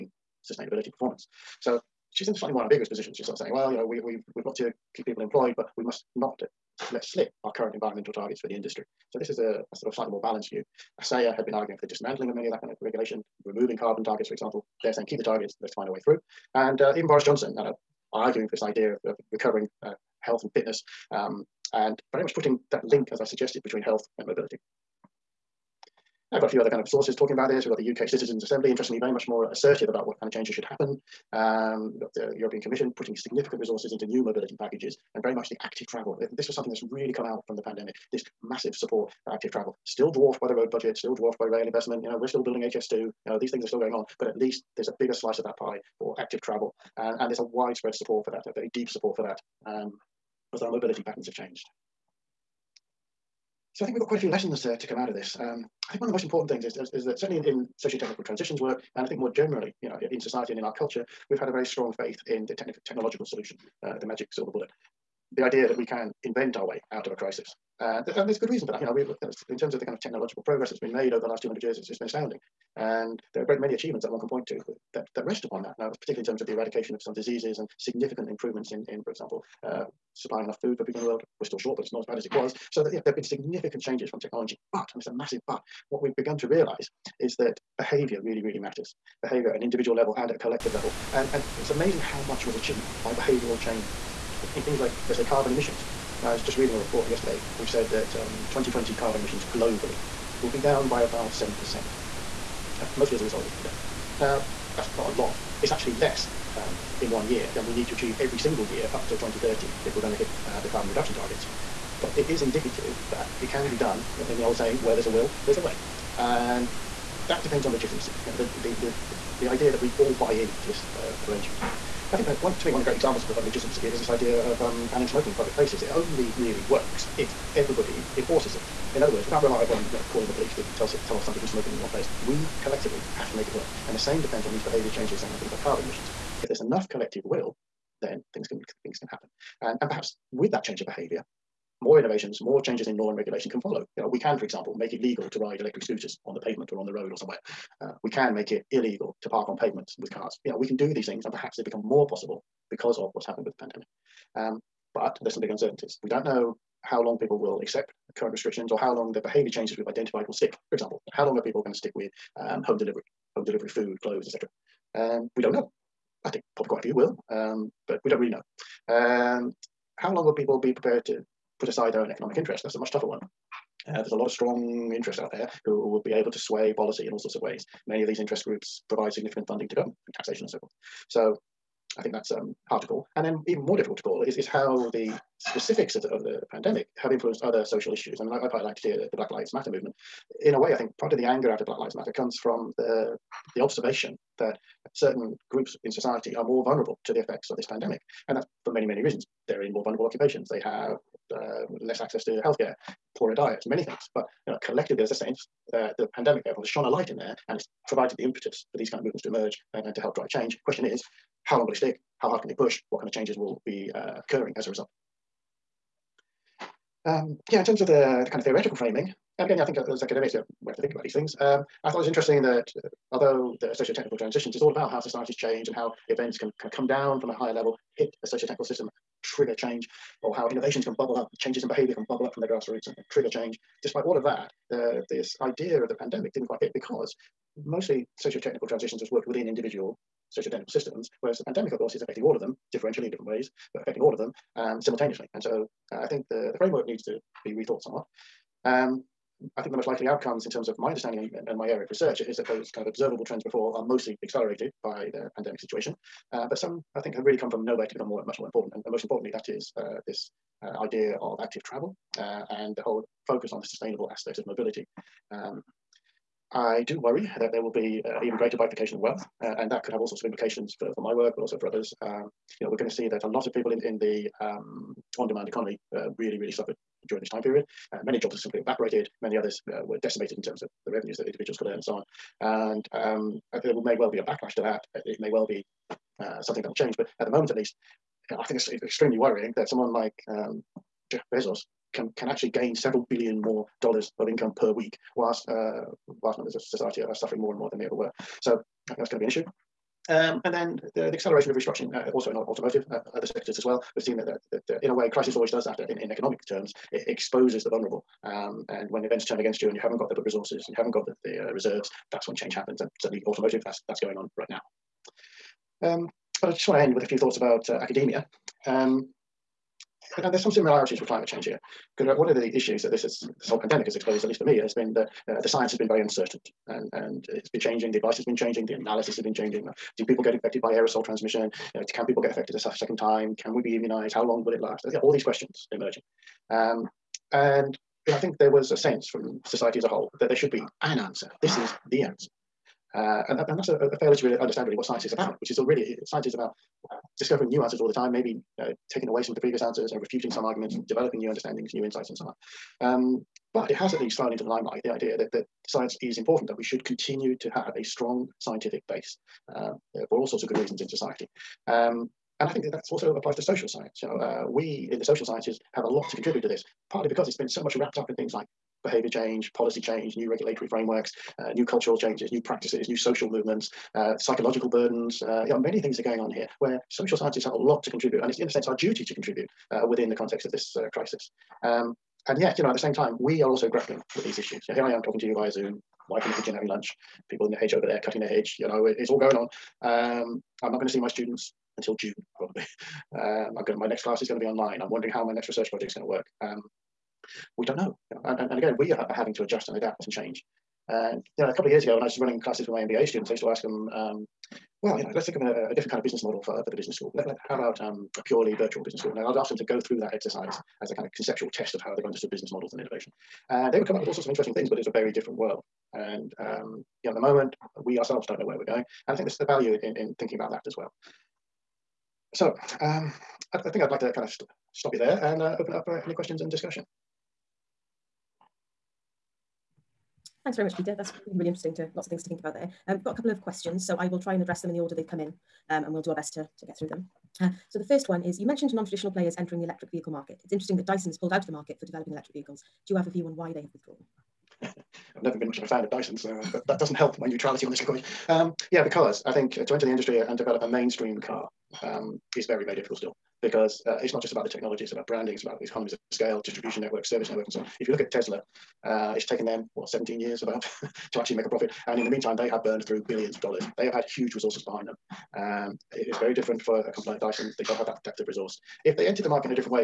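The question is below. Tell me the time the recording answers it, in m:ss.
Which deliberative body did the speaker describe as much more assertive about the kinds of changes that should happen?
0:27.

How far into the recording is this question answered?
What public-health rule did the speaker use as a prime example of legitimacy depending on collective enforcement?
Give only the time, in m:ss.
2:04.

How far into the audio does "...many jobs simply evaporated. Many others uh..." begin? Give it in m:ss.
4:38.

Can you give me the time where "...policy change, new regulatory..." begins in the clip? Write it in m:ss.
6:09.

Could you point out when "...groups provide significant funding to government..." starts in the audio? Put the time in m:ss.
2:58.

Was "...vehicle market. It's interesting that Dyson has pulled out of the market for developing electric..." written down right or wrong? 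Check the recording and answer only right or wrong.
right.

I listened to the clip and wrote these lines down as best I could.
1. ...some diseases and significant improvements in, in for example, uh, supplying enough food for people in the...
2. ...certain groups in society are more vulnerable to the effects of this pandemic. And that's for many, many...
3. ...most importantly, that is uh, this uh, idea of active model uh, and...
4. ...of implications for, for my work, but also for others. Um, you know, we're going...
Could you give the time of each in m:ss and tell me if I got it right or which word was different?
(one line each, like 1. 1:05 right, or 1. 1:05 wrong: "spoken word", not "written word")
1. 1:17 right
2. 3:14 right
3. 4:18 wrong: "travel", not "model"
4. 4:30 right.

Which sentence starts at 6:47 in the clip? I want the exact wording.
Let, let, how about um, a purely virtual business school?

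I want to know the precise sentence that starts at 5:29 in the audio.
Uh, do people get infected by aerosol transmission?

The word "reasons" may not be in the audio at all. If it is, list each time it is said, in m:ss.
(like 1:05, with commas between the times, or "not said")
1:08, 3:19, 6:00.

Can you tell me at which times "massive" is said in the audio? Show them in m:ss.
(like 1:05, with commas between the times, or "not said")
0:38, 1:25.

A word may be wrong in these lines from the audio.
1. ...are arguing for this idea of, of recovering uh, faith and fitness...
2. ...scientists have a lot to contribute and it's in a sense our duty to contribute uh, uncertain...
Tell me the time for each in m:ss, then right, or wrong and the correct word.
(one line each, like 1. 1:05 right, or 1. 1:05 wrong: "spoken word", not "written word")
1. 0:18 wrong: "health", not "faith"
2. 6:17 wrong: "within", not "uncertain".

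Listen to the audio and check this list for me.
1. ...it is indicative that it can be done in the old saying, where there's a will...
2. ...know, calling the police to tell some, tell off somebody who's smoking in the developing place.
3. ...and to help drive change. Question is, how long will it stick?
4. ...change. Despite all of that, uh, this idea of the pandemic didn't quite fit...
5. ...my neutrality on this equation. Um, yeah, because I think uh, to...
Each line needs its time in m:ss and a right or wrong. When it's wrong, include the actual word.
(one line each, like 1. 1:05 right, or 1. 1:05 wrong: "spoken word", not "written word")
1. 1:52 right
2. 2:09 wrong: "wrong", not "developing"
3. 3:29 right
4. 3:53 right
5. 7:27 right.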